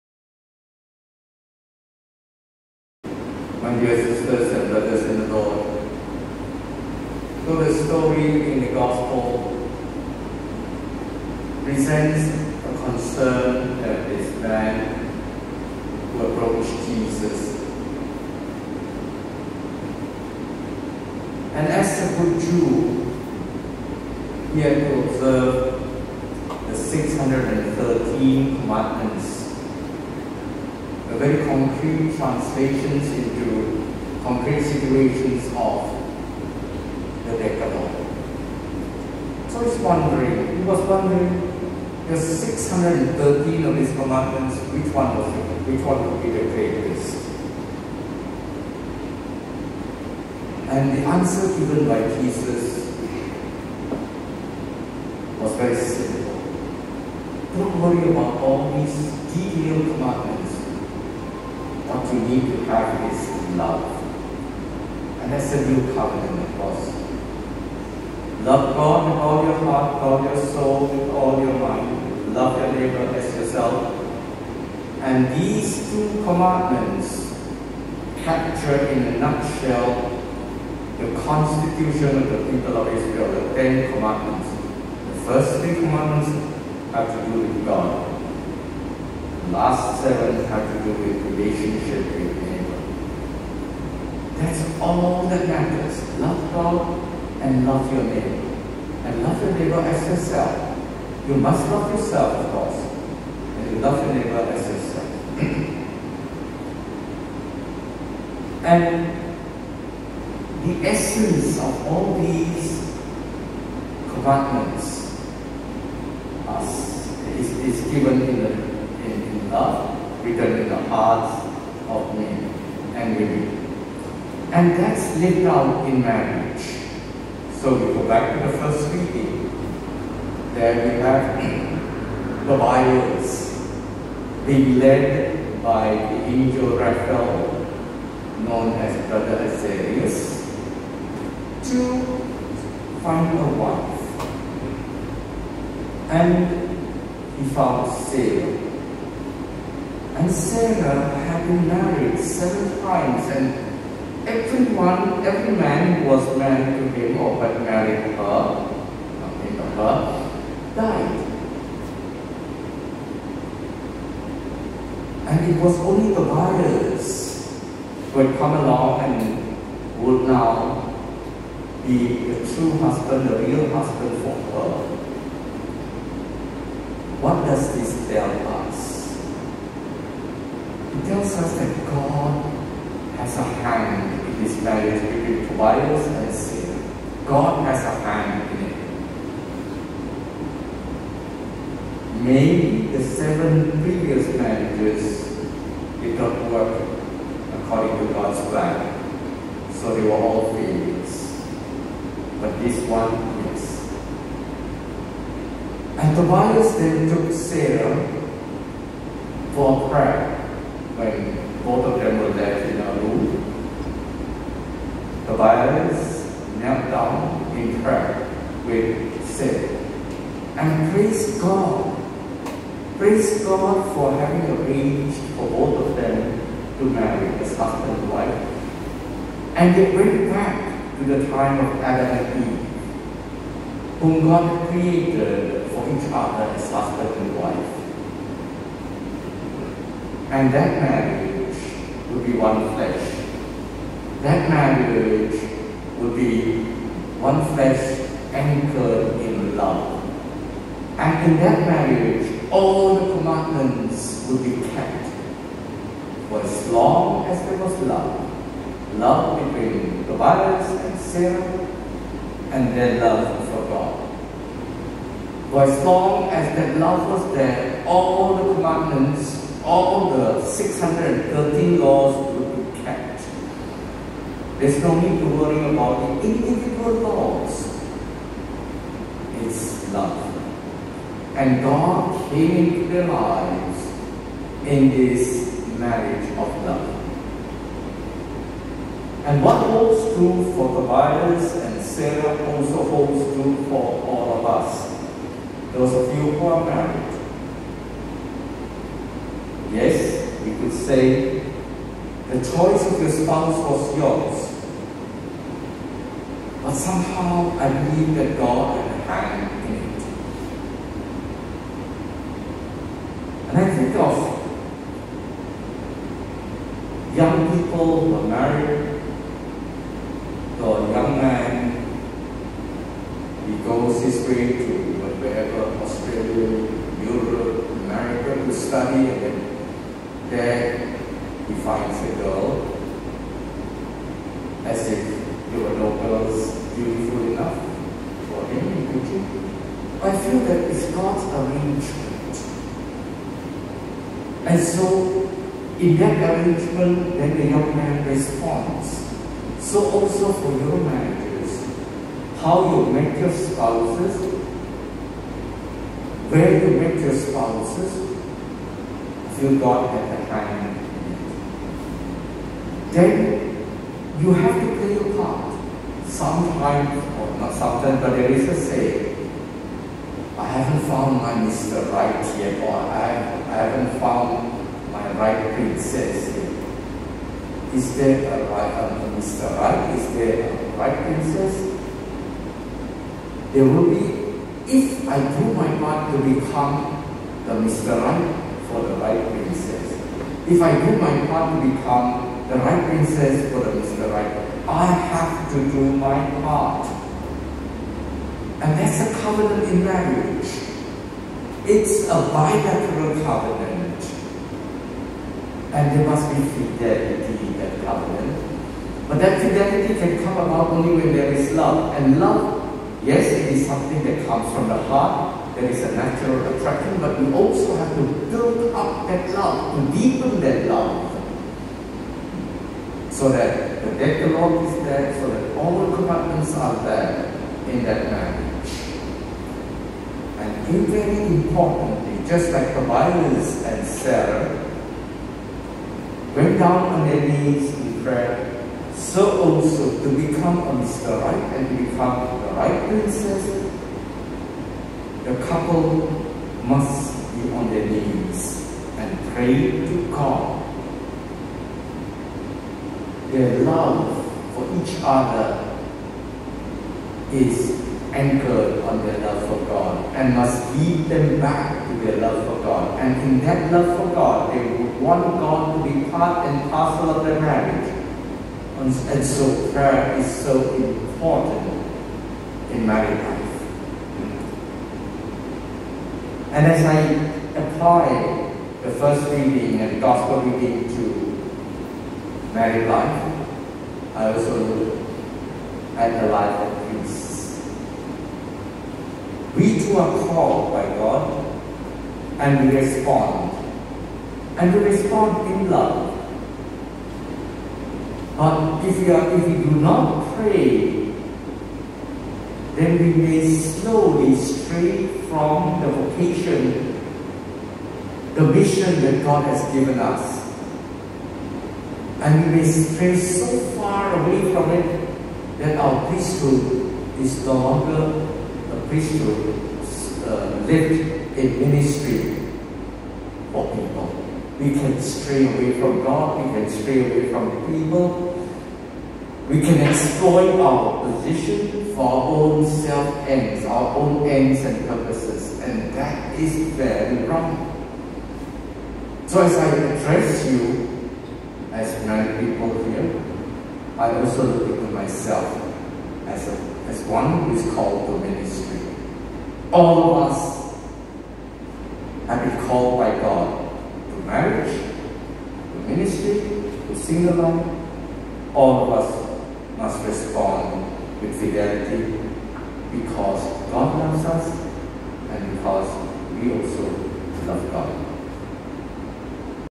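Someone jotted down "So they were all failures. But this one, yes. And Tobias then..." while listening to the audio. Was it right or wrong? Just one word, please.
right.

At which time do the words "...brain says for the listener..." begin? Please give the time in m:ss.
6:32.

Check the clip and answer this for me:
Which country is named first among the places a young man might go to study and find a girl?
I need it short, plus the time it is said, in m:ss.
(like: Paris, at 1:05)
Australia, at 5:25.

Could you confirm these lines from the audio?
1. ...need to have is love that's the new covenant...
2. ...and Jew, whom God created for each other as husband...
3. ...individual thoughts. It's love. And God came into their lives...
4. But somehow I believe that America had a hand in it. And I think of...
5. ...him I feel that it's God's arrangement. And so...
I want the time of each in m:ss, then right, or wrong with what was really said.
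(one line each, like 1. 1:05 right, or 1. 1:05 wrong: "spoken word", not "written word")
1. 1:02 right
2. 3:52 wrong: "Eve", not "Jew"
3. 4:36 right
4. 5:06 wrong: "God", not "America"
5. 5:38 right.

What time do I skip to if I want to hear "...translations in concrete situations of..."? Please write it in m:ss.
0:32.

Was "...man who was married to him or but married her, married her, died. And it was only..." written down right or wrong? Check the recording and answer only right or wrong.
right.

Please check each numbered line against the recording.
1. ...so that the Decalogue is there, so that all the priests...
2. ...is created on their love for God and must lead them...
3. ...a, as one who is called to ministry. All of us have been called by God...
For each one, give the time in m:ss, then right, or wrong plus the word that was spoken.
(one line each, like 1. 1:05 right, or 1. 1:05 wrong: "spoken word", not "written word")
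1. 7:03 wrong: "commandments", not "priests"
2. 7:37 wrong: "anchored", not "created"
3. 9:06 right.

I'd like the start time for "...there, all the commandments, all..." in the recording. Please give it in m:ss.
4:27.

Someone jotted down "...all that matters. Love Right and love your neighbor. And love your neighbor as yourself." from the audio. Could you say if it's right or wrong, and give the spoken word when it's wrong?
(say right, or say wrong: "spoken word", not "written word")
wrong: "God", not "Right".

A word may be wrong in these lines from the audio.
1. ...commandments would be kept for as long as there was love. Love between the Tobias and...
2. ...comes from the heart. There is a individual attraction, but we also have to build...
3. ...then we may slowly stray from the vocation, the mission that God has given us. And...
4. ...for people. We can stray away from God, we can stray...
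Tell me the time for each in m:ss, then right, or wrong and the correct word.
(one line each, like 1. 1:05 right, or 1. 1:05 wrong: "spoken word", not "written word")
1. 4:13 right
2. 6:54 wrong: "natural", not "individual"
3. 8:22 right
4. 8:43 right.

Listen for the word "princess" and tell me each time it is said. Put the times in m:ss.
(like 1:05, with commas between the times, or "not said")
6:15, 6:21, 6:29, 7:22.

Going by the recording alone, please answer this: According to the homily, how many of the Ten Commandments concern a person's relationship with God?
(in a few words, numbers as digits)
3.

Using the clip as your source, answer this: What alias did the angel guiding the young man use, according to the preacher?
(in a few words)
Brother Azarius.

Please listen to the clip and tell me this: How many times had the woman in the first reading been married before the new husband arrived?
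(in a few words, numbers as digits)
7.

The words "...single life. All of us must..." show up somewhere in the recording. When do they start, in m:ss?
9:16.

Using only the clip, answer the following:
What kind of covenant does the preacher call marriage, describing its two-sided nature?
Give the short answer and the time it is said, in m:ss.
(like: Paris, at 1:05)
bilateral covenant, at 6:42.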